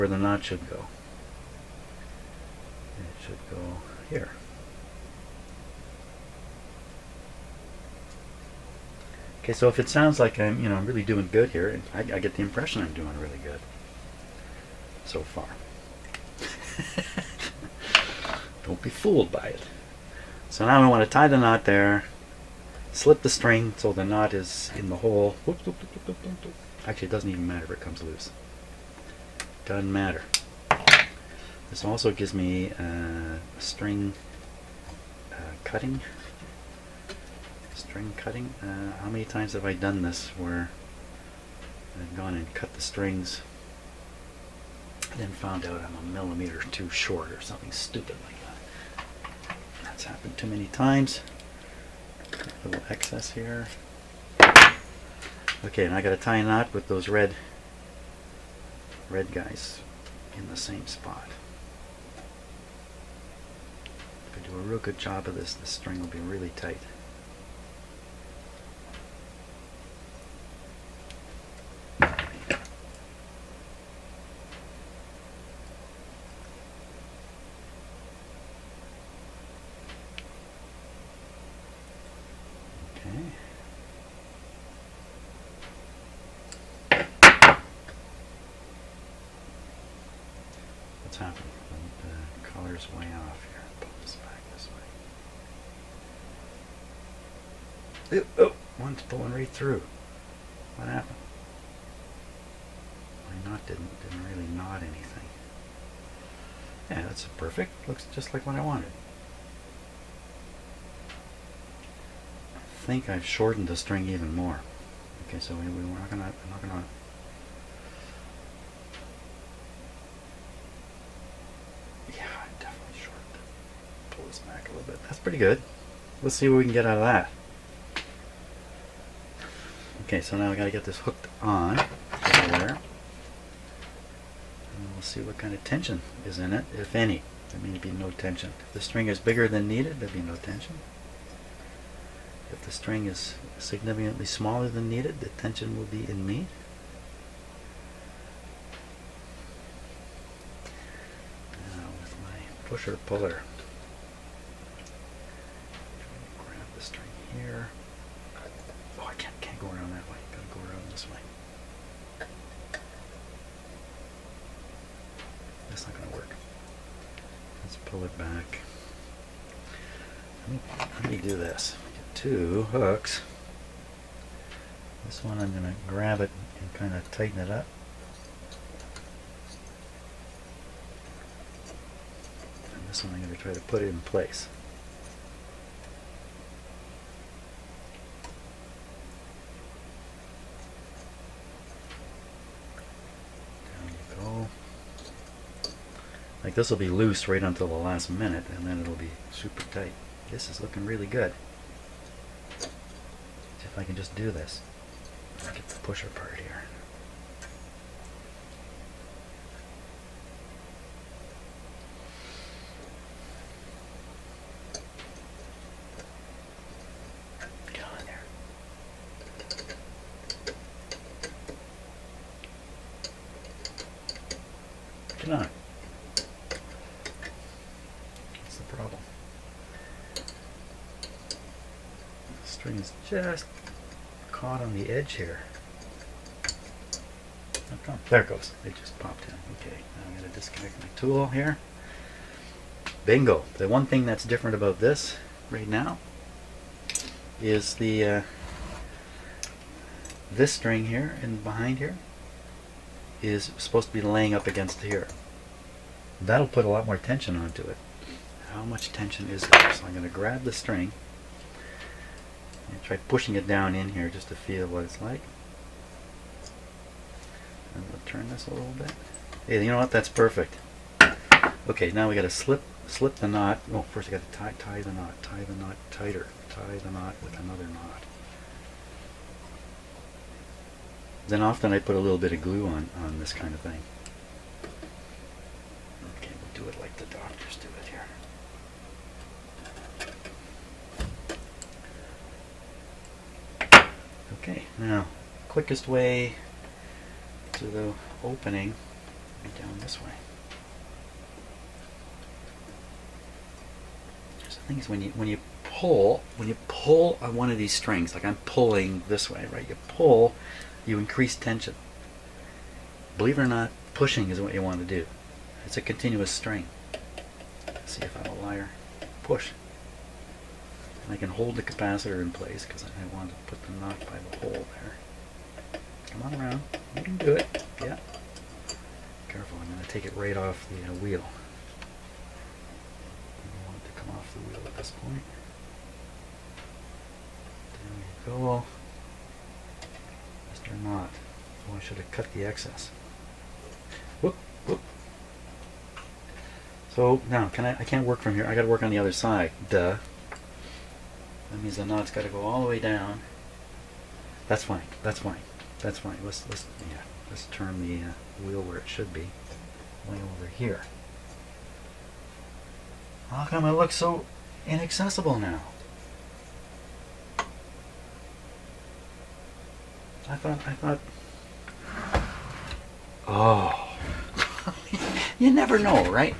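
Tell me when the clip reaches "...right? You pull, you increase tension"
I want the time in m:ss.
5:09.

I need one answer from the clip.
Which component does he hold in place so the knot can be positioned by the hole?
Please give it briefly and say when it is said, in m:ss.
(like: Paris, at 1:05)
capacitor, at 5:21.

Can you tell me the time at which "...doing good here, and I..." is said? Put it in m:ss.
0:11.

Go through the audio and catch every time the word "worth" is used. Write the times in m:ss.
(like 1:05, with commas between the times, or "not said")
not said.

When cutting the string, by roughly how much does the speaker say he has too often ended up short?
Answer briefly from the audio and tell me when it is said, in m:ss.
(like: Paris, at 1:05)
a millimeter, at 0:45.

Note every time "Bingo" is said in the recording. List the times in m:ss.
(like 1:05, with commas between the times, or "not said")
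4:03.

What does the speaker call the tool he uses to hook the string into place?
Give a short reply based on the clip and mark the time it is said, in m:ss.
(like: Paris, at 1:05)
pusher puller, at 2:32.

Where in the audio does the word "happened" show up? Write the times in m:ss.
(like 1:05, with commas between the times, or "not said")
0:50, 1:40.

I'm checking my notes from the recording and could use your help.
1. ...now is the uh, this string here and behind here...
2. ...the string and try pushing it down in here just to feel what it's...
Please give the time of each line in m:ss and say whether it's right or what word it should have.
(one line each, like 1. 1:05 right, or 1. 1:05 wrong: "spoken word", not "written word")
1. 4:05 right
2. 4:20 right.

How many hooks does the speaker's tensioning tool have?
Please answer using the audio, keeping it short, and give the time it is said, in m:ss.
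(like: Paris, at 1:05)
2, at 2:52.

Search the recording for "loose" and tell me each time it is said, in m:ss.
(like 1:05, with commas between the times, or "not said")
0:28, 3:16.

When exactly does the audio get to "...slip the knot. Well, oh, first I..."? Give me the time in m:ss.
4:32.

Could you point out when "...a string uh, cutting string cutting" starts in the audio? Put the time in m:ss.
0:33.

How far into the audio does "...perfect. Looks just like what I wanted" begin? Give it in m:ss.
1:47.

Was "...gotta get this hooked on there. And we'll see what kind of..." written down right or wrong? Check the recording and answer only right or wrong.
right.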